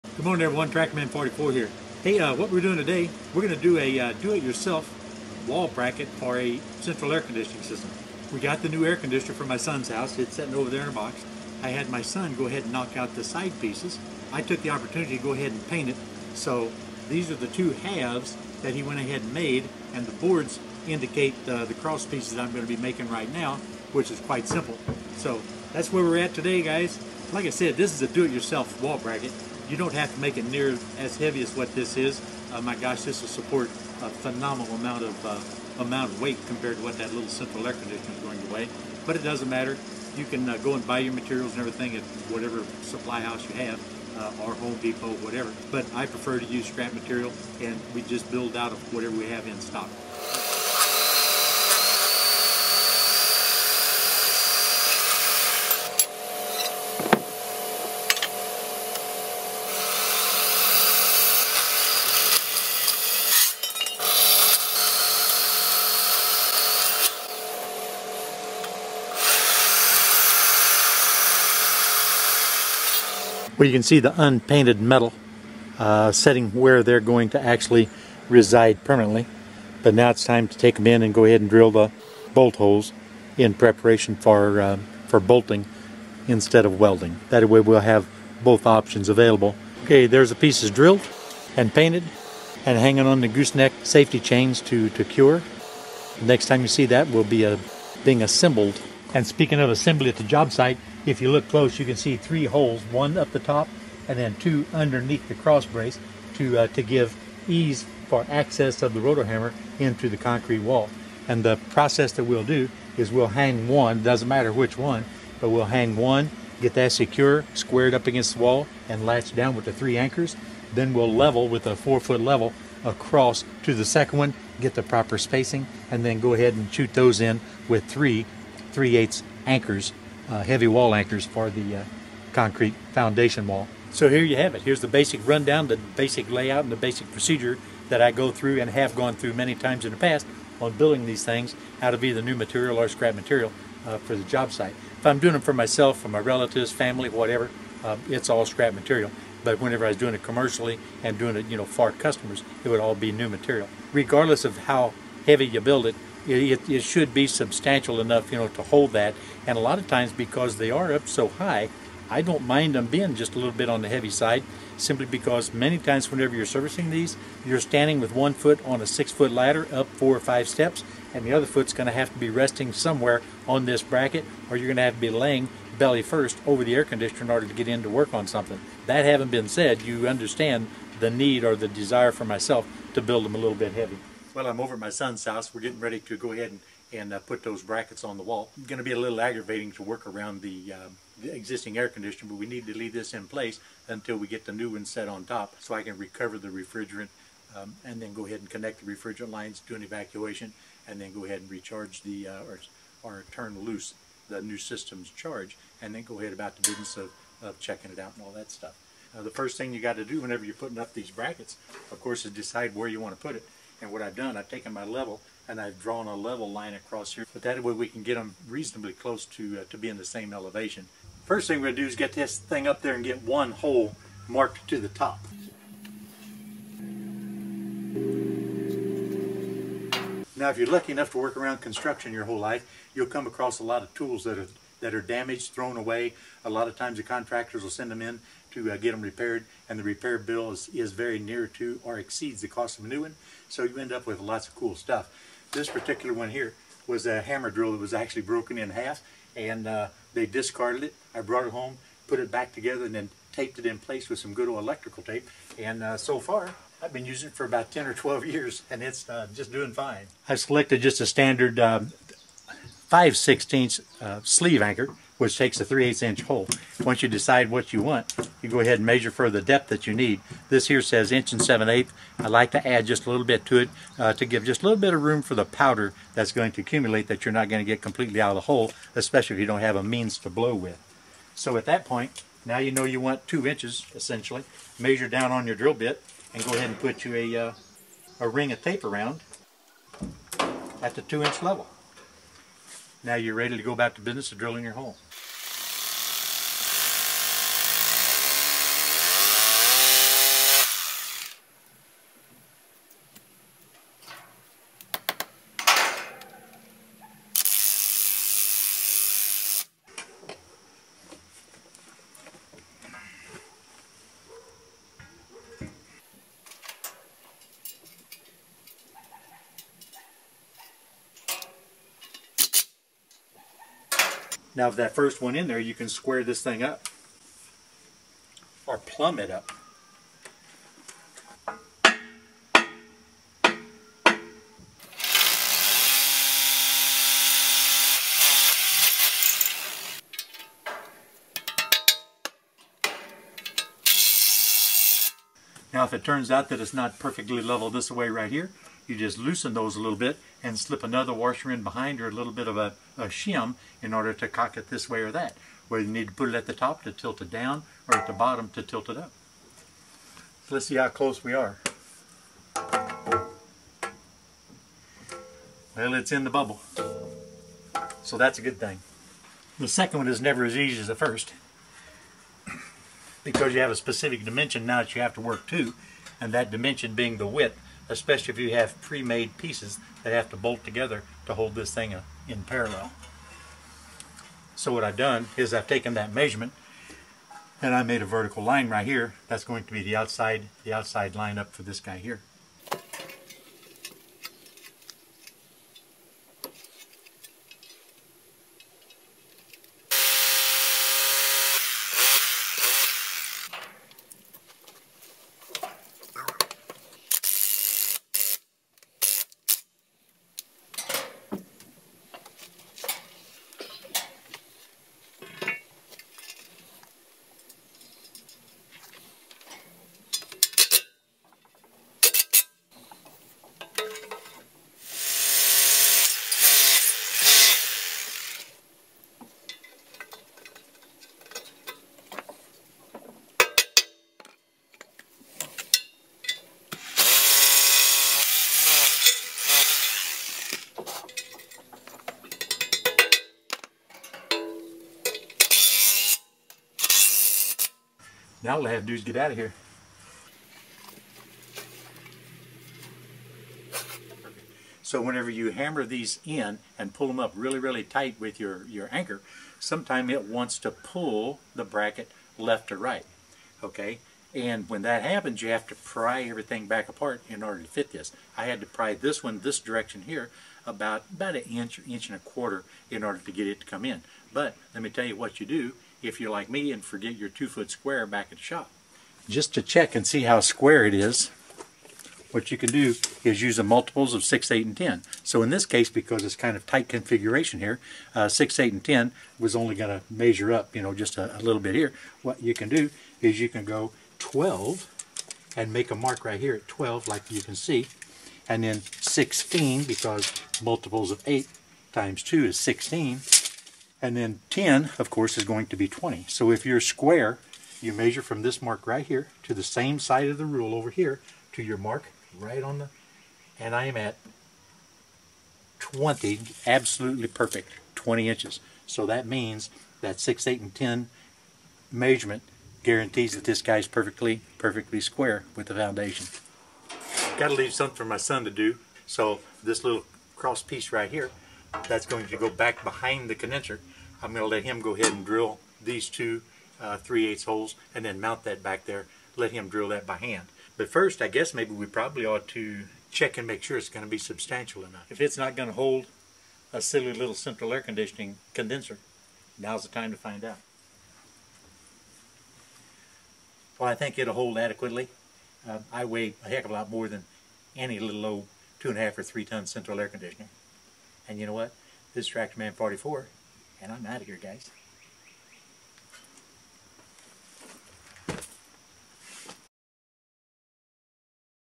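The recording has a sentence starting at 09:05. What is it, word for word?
If it's not going to hold a silly little central air conditioning condenser, now's the time to find out.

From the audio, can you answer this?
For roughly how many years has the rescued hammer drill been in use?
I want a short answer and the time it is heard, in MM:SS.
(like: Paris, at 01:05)
10 or 12 years, at 04:17.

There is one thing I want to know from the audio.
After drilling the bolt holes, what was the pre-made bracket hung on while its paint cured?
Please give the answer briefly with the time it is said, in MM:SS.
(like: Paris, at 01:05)
Gooseneck safety chains, at 01:33.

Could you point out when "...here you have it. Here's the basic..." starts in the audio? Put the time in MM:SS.
02:14.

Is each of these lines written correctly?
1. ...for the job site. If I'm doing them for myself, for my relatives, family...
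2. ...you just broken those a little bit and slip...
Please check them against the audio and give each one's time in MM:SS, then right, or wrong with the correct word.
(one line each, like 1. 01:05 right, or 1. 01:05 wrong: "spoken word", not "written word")
1. 02:23 right
2. 05:48 wrong: "loosen", not "broken".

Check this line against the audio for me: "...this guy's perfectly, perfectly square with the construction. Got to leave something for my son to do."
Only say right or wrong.
wrong.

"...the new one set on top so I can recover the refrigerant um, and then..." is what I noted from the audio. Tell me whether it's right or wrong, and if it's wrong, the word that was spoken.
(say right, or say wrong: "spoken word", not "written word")
right.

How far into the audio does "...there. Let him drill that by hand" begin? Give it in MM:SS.
08:58.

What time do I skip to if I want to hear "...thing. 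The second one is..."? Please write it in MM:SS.
06:08.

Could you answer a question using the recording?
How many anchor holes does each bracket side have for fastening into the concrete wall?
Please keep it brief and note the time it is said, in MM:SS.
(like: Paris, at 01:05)
3, at 01:42.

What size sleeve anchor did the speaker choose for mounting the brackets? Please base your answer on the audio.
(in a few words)
5/16.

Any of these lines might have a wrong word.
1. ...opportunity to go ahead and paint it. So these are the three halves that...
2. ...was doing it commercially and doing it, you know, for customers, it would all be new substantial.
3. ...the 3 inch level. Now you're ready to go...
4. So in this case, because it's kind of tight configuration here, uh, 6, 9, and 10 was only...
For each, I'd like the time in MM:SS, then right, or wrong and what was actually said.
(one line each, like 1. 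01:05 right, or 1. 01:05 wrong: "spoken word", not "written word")
1. 00:14 wrong: "two", not "three"
2. 02:29 wrong: "material", not "substantial"
3. 04:50 wrong: "2", not "3"
4. 08:05 wrong: "8", not "9".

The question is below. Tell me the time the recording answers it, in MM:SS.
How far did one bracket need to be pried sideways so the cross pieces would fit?
07:51.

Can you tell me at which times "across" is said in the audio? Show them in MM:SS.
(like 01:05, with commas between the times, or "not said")
02:02, 03:36, 03:53.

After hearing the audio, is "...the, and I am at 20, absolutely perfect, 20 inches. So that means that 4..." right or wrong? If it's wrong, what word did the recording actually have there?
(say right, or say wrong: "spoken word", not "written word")
wrong: "6", not "4".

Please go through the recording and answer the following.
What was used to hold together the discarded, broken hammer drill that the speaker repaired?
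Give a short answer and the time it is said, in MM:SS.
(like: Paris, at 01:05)
Electrical tape, at 04:14.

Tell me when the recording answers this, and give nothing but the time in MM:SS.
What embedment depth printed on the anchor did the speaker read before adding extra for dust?
04:31.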